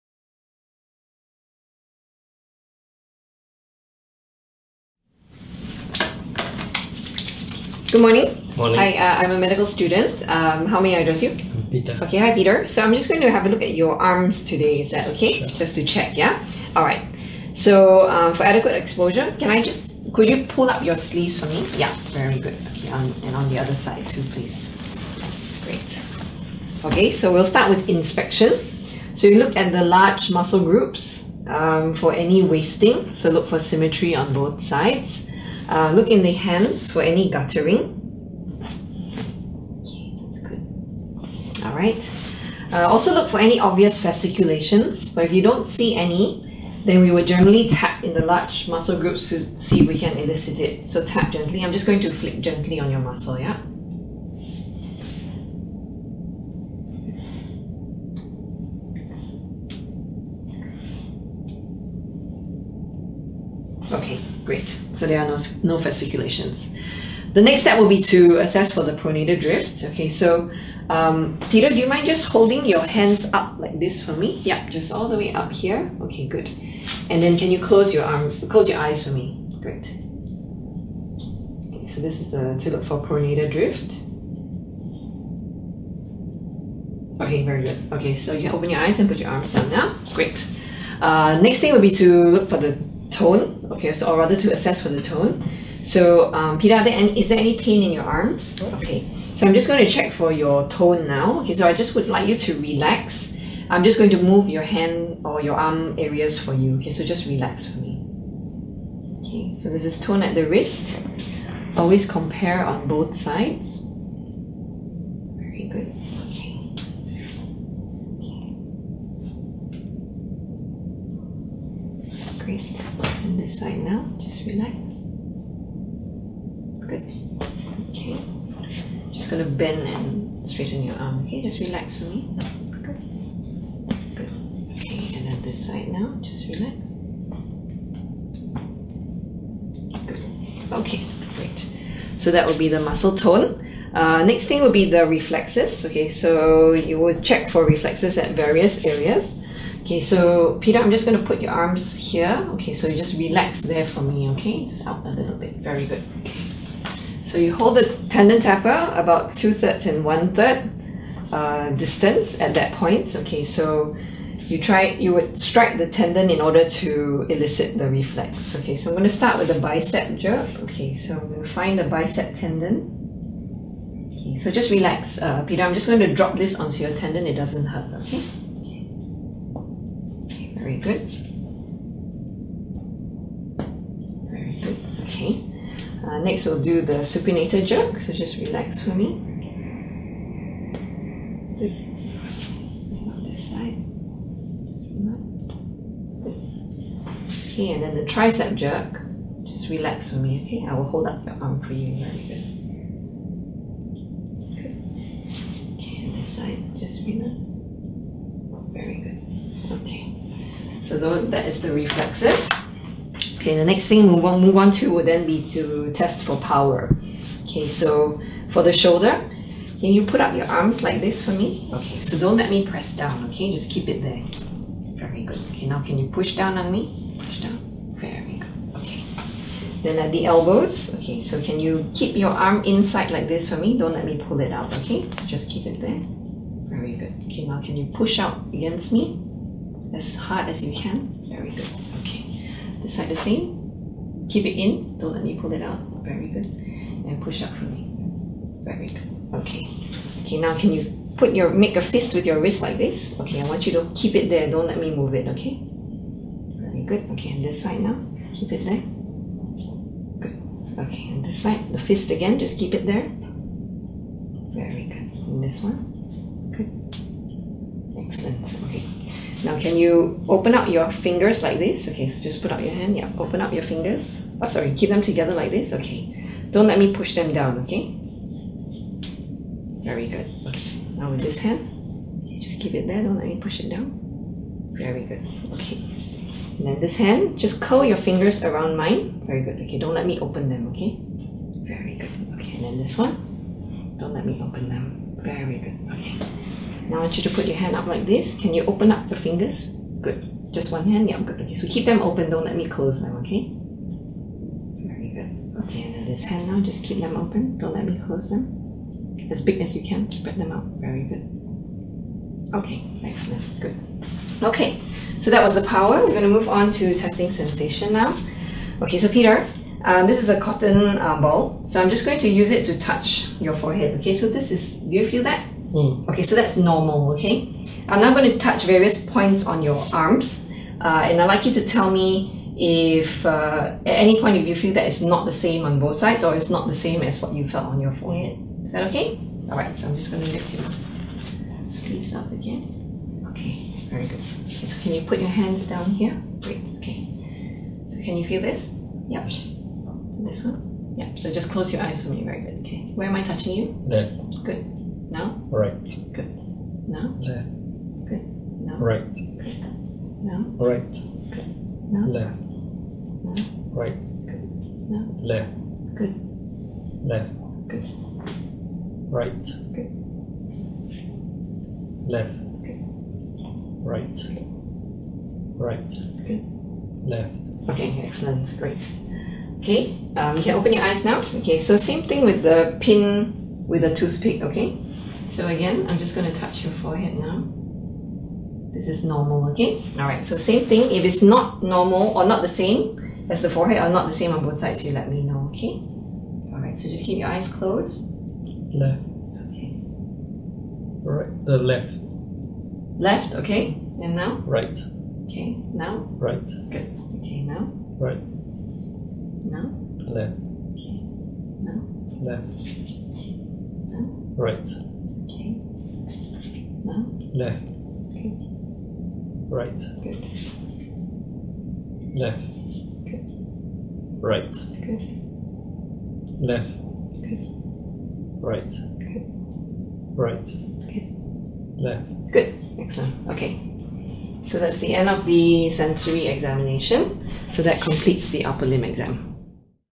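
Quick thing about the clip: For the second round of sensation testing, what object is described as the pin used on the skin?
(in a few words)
toothpick.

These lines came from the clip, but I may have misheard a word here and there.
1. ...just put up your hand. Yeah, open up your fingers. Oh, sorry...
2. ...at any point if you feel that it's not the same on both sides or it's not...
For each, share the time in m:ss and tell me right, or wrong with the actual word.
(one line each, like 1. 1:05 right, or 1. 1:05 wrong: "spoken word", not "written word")
1. 4:32 right
2. 5:33 right.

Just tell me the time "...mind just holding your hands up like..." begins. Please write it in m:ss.
1:11.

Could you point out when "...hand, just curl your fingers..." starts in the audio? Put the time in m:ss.
4:46.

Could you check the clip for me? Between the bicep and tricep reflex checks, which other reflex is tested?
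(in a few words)
supinator jerk.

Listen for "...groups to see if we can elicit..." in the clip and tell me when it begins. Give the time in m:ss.
0:48.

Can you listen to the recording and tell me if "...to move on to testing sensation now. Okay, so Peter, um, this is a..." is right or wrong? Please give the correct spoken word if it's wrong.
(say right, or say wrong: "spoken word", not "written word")
right.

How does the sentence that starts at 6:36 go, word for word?
Alright, so just keep your eyes closed.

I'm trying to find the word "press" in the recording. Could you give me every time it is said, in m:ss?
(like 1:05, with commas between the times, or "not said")
3:42.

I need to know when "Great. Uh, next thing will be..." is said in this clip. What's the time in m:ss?
1:30.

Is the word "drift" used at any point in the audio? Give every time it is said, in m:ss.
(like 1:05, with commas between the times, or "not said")
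1:09, 1:23.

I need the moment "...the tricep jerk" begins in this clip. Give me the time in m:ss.
3:17.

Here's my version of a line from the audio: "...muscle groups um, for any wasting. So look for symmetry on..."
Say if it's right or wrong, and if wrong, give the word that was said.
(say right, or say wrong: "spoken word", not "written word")
right.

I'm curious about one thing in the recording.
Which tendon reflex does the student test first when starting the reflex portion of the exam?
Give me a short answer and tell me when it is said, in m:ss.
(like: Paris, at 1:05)
bicep jerk, at 2:49.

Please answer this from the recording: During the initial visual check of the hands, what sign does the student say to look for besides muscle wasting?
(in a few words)
guttering.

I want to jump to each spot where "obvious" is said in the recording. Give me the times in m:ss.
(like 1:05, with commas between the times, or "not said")
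0:43.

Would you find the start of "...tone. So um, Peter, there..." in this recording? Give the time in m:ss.
1:34.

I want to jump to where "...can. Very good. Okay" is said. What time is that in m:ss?
4:00.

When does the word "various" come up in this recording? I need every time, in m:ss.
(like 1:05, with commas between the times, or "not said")
2:28, 5:28.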